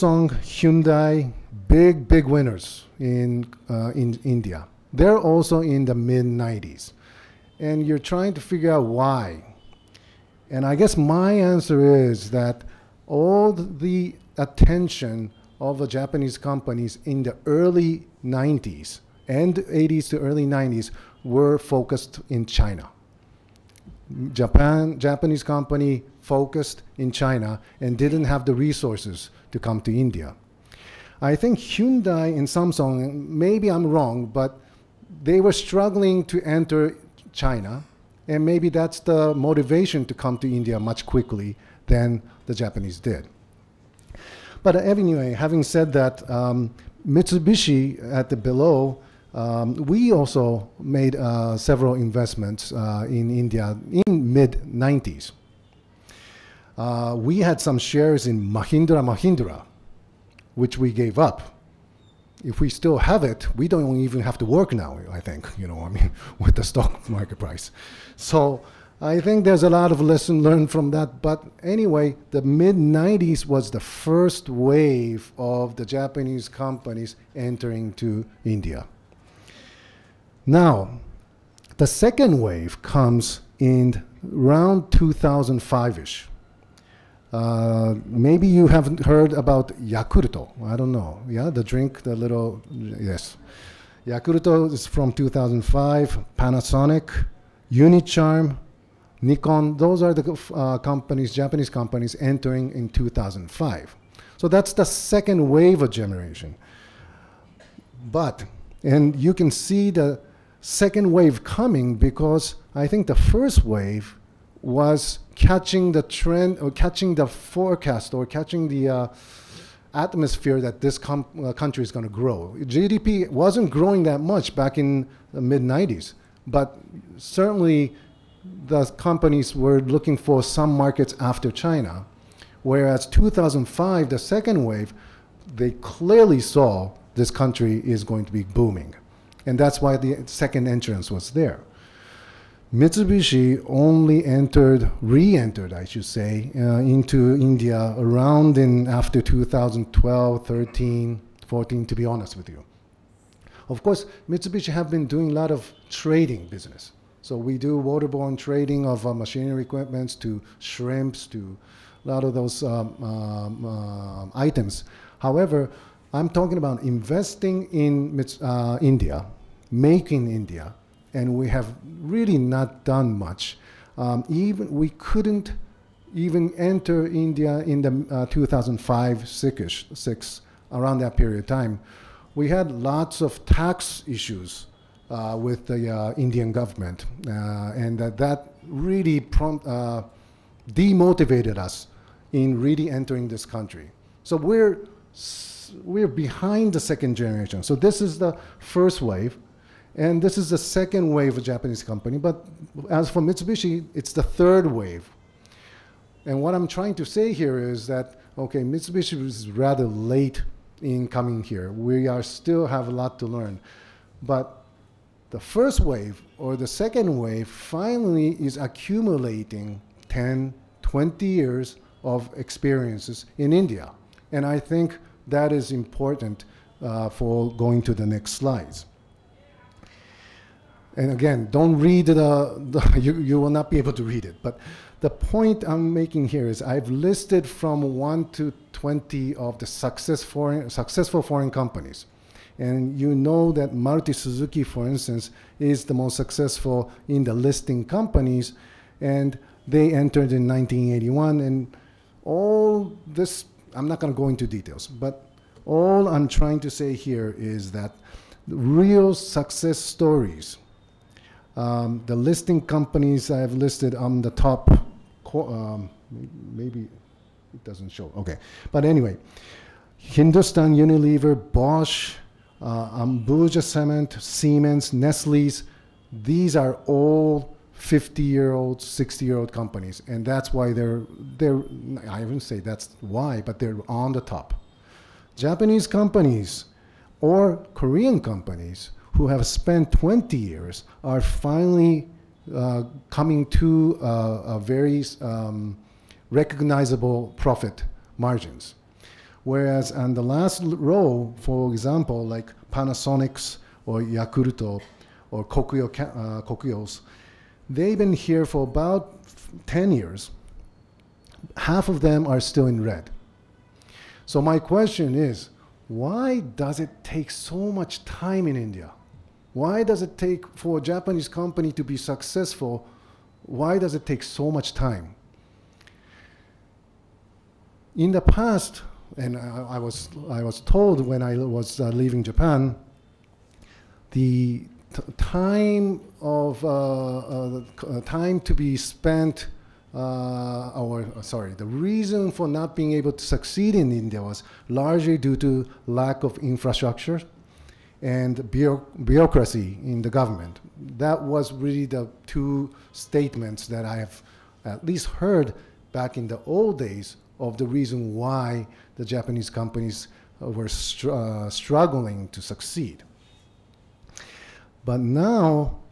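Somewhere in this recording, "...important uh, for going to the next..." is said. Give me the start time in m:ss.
3:45.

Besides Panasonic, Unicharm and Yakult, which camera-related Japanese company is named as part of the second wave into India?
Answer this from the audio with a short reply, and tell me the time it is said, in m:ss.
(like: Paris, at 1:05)
Nikon, at 1:39.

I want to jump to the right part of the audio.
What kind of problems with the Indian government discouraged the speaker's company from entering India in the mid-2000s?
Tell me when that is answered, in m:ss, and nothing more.
3:03.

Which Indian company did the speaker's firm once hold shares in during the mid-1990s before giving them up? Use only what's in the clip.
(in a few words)
Mahindra & Mahindra.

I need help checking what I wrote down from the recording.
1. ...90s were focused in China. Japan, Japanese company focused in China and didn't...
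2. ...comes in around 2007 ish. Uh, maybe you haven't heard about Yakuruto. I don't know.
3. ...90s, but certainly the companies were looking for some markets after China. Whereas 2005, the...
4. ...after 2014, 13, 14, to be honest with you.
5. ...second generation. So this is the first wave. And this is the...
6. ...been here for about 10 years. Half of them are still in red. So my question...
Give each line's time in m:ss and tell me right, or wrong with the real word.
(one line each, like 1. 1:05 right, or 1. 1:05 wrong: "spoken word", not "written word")
1. 0:20 right
2. 1:22 wrong: "2005", not "2007"
3. 2:05 right
4. 2:28 wrong: "2012", not "2014"
5. 3:16 right
6. 5:07 right.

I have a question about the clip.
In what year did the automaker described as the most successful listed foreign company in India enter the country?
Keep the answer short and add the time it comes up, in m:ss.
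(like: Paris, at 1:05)
1981, at 4:10.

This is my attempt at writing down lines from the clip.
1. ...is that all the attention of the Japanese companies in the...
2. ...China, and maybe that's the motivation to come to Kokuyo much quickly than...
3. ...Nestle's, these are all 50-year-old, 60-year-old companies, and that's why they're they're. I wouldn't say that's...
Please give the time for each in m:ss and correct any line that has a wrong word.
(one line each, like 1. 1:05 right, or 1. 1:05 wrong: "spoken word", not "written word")
1. 0:12 right
2. 0:37 wrong: "India", not "Kokuyo"
3. 4:34 right.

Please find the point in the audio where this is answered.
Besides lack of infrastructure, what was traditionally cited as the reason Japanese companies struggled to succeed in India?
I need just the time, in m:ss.
5:48.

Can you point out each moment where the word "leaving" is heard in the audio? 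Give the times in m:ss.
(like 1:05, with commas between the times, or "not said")
5:31.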